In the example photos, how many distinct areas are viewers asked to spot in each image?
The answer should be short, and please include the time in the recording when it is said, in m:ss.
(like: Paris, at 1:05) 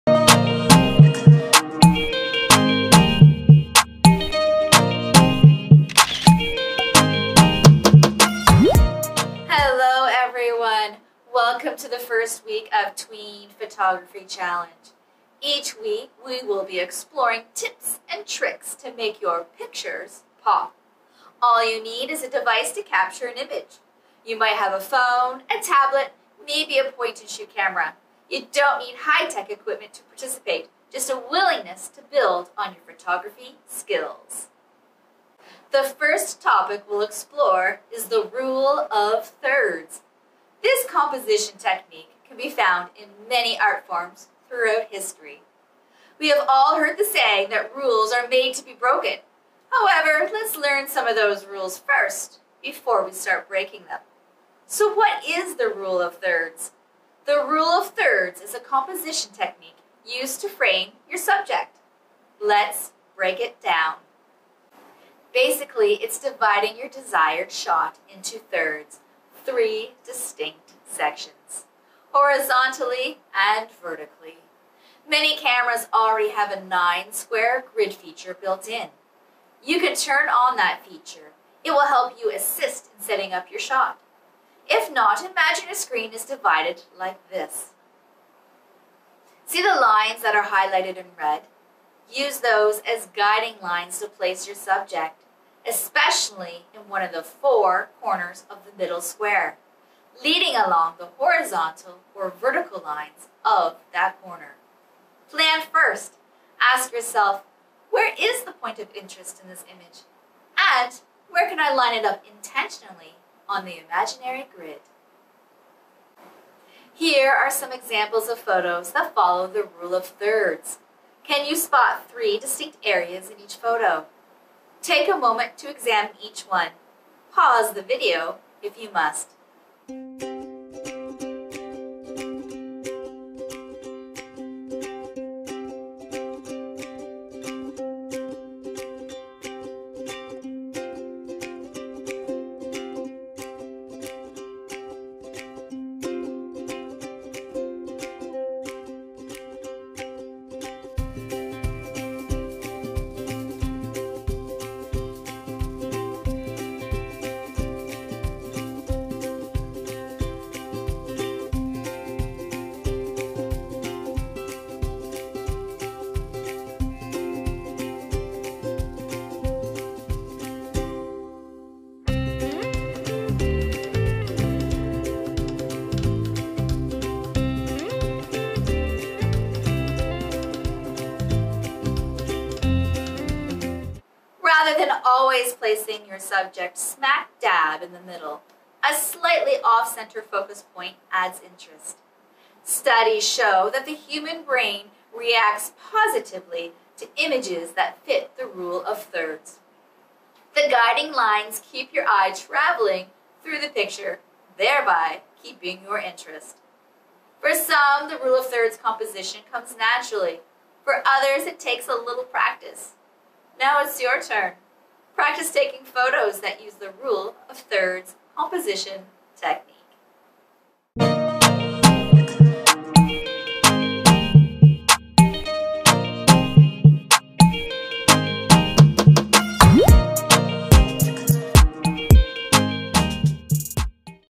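3, at 2:02.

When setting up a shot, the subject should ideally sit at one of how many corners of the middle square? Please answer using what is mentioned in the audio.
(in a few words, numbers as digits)
4.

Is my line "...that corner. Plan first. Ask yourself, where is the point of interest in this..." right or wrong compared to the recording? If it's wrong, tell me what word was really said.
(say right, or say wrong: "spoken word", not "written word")
right.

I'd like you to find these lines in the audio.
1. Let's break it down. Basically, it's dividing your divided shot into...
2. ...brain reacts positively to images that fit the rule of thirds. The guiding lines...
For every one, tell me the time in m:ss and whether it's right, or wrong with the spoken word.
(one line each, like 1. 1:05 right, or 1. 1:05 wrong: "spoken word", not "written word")
1. 1:02 wrong: "desired", not "divided"
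2. 3:14 right.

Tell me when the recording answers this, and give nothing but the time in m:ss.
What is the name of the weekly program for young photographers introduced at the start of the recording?
0:12.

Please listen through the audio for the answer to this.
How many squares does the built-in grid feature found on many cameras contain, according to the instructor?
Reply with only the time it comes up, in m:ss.
1:16.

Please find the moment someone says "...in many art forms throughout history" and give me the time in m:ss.
0:42.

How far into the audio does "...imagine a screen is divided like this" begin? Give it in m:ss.
1:25.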